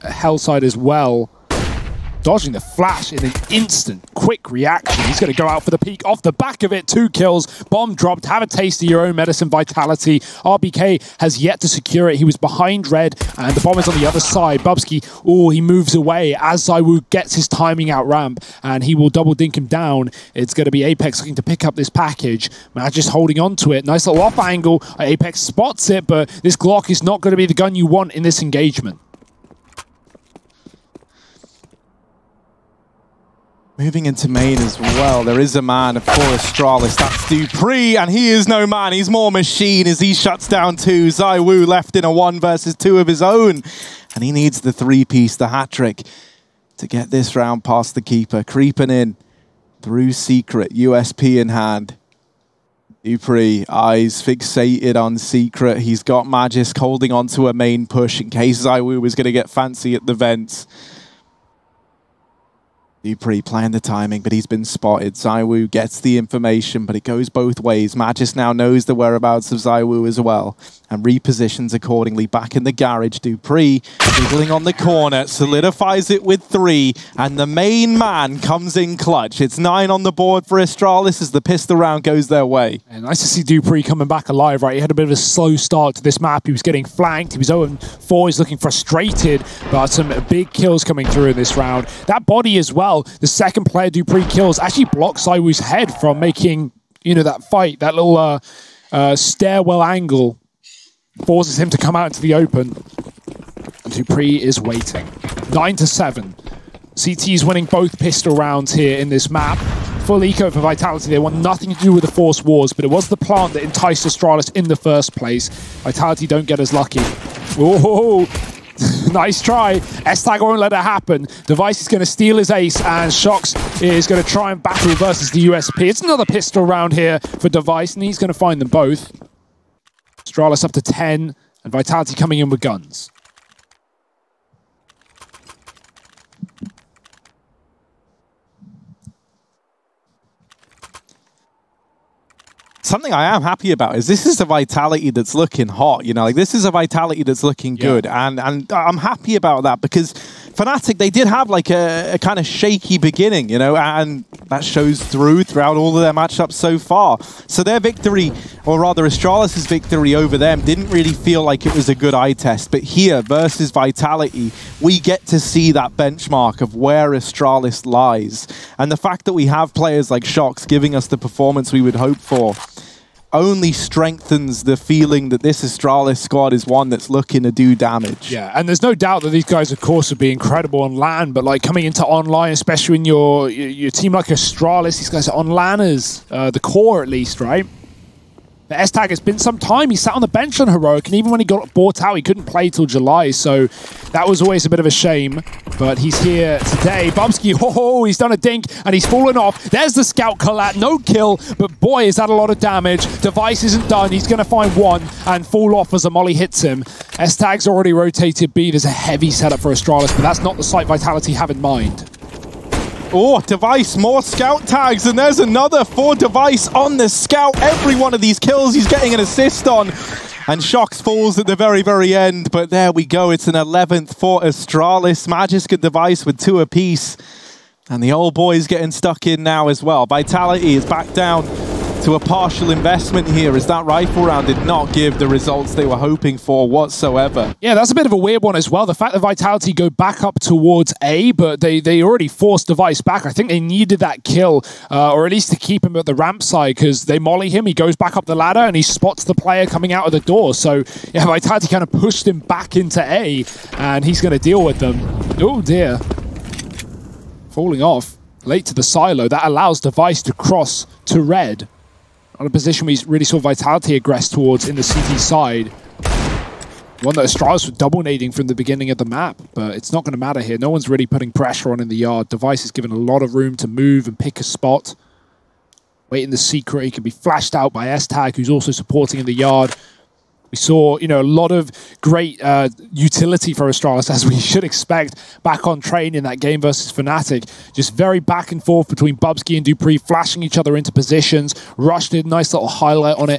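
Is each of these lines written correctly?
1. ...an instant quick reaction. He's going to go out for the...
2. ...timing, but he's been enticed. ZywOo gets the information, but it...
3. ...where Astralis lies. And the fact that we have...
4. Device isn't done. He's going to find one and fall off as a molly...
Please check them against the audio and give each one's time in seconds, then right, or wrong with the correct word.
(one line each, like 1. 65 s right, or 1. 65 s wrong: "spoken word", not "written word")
1. 3 s right
2. 63 s wrong: "spotted", not "enticed"
3. 166 s right
4. 203 s right.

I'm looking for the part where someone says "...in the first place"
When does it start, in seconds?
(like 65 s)
114 s.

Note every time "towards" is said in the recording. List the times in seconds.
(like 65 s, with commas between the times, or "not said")
240 s, 264 s.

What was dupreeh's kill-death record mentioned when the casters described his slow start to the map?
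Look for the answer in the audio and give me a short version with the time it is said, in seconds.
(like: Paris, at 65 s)
0-4, at 87 s.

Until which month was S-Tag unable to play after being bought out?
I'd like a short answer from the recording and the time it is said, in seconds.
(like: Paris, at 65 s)
July, at 192 s.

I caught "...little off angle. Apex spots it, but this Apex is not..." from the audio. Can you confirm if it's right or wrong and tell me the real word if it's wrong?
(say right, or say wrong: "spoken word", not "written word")
wrong: "Glock", not "Apex".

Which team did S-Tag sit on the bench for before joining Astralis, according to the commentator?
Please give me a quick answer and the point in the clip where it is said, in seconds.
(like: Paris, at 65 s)
Heroic, at 190 s.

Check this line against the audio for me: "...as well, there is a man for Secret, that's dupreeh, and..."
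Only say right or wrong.
wrong.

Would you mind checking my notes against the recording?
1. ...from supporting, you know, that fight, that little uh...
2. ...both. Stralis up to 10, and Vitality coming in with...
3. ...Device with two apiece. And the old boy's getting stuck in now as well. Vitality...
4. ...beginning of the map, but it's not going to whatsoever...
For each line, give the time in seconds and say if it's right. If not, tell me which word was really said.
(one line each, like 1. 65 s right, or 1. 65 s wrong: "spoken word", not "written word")
1. 96 s wrong: "making", not "supporting"
2. 128 s right
3. 225 s right
4. 268 s wrong: "matter", not "whatsoever".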